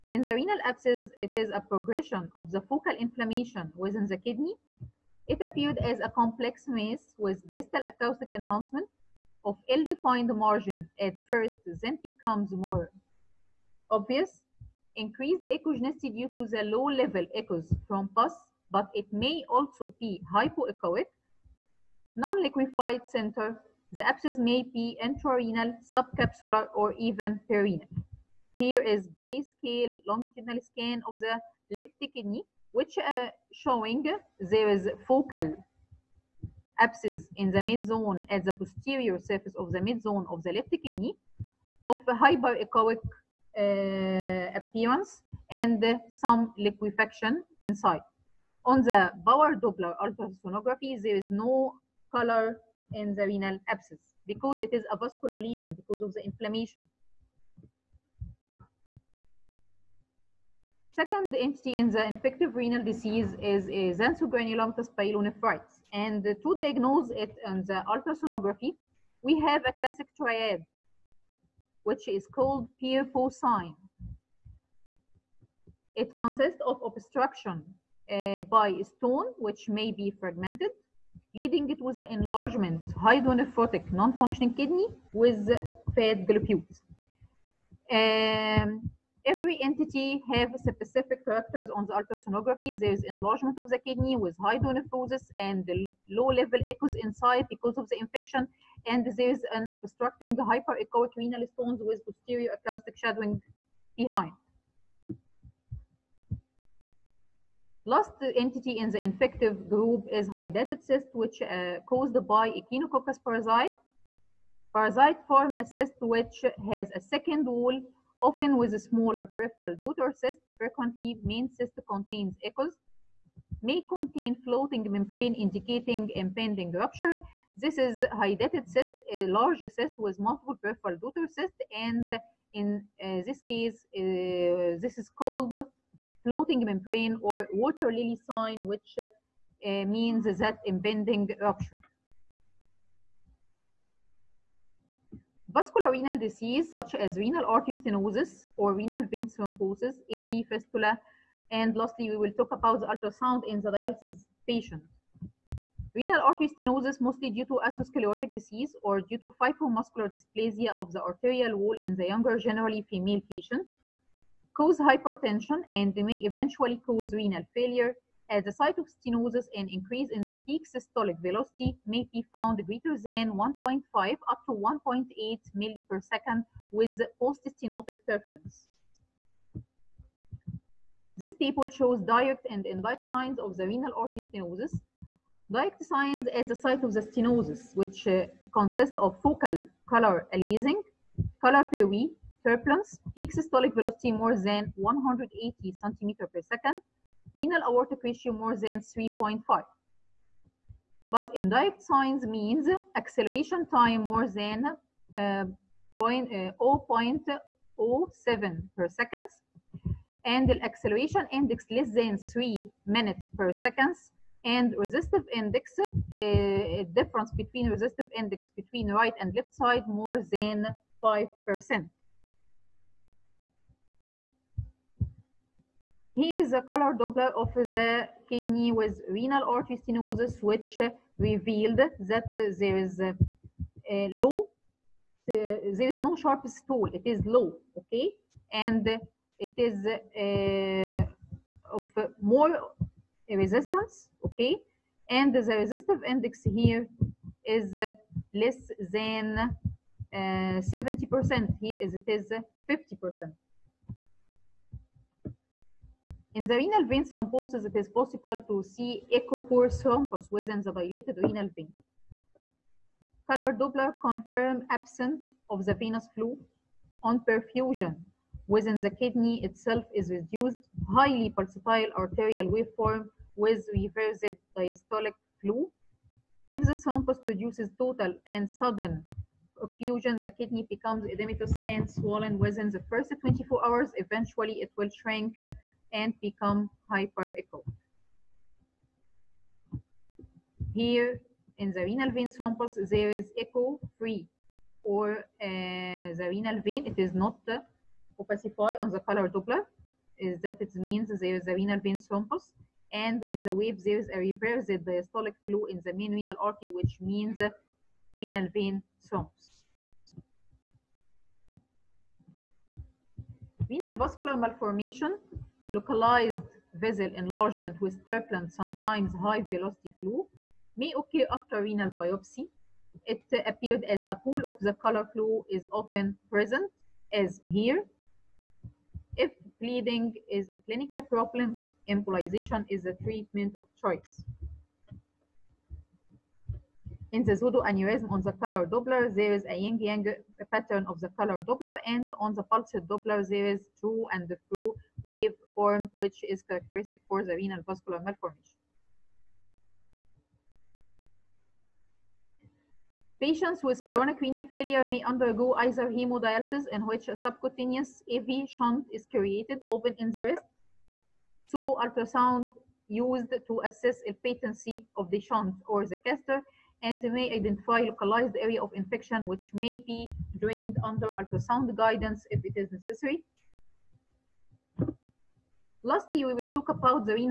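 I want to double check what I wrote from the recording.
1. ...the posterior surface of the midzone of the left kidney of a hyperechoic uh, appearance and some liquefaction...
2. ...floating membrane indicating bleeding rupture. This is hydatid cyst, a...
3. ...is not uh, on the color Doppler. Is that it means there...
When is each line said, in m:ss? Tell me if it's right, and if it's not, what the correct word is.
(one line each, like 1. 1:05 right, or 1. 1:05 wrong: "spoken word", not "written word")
1. 0:38 right
2. 2:04 wrong: "impending", not "bleeding"
3. 4:56 right.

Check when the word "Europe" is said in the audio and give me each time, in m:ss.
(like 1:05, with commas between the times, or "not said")
not said.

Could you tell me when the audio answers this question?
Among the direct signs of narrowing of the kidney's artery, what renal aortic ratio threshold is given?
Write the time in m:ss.
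3:18.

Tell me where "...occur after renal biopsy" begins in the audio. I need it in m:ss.
5:21.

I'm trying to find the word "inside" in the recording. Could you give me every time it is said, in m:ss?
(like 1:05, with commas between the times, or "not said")
0:47, 1:36.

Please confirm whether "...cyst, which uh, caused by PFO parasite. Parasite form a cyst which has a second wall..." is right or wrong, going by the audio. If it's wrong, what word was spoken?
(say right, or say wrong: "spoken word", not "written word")
wrong: "Echinococcus", not "PFO".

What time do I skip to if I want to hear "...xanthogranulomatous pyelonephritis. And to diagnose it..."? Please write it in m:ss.
1:03.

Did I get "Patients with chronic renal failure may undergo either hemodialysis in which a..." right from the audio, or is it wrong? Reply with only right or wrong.
right.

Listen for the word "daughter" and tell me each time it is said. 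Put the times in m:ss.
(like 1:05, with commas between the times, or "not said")
1:59, 2:10.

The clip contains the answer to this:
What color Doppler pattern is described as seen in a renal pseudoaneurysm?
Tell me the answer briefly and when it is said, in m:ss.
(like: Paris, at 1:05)
yin-yang pattern, at 5:39.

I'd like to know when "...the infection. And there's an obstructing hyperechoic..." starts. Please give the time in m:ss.
1:37.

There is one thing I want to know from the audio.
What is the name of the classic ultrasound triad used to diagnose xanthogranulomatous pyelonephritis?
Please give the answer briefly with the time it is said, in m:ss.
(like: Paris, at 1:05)
PFO sign, at 1:12.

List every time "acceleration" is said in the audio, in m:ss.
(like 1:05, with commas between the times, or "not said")
3:22, 3:30.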